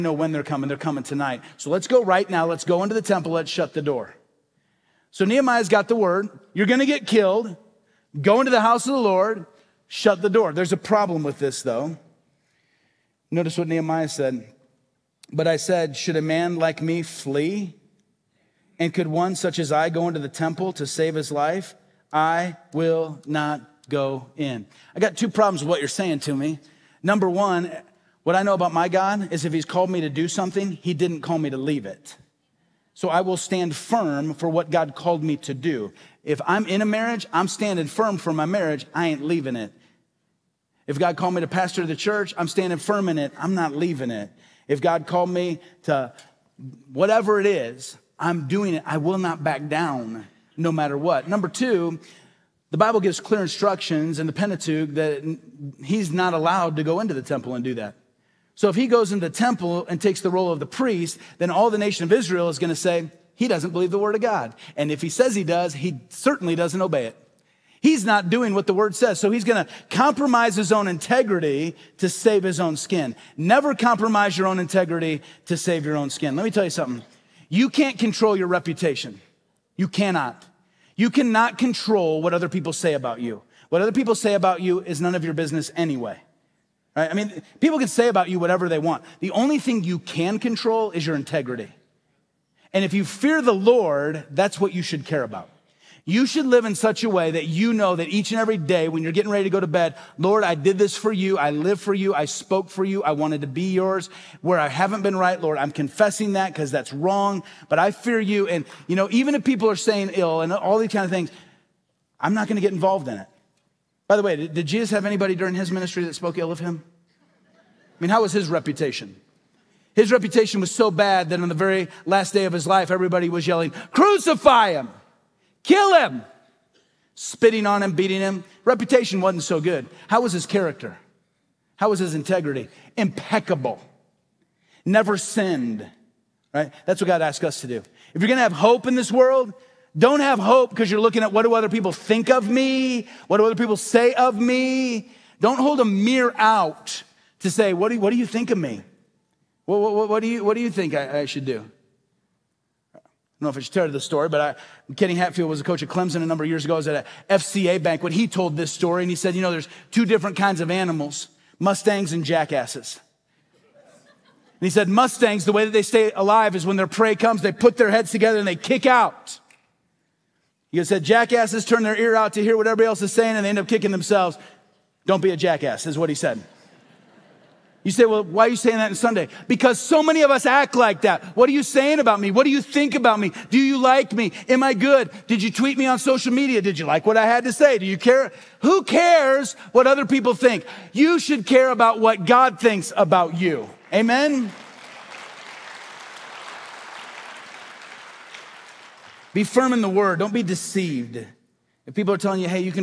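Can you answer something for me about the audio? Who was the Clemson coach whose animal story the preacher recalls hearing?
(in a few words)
Kenny Hatfield.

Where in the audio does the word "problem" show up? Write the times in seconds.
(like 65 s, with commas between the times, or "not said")
10 s, 25 s.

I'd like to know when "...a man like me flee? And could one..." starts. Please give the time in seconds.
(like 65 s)
16 s.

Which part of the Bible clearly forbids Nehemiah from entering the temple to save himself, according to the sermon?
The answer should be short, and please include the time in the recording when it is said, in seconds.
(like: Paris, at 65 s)
Pentateuch, at 54 s.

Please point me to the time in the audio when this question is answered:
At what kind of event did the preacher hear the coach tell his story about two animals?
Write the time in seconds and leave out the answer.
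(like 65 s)
157 s.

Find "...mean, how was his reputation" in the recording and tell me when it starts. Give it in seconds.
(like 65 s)
118 s.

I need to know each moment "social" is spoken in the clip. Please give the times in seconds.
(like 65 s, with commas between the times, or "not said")
185 s.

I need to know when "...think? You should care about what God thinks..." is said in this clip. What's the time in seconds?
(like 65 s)
190 s.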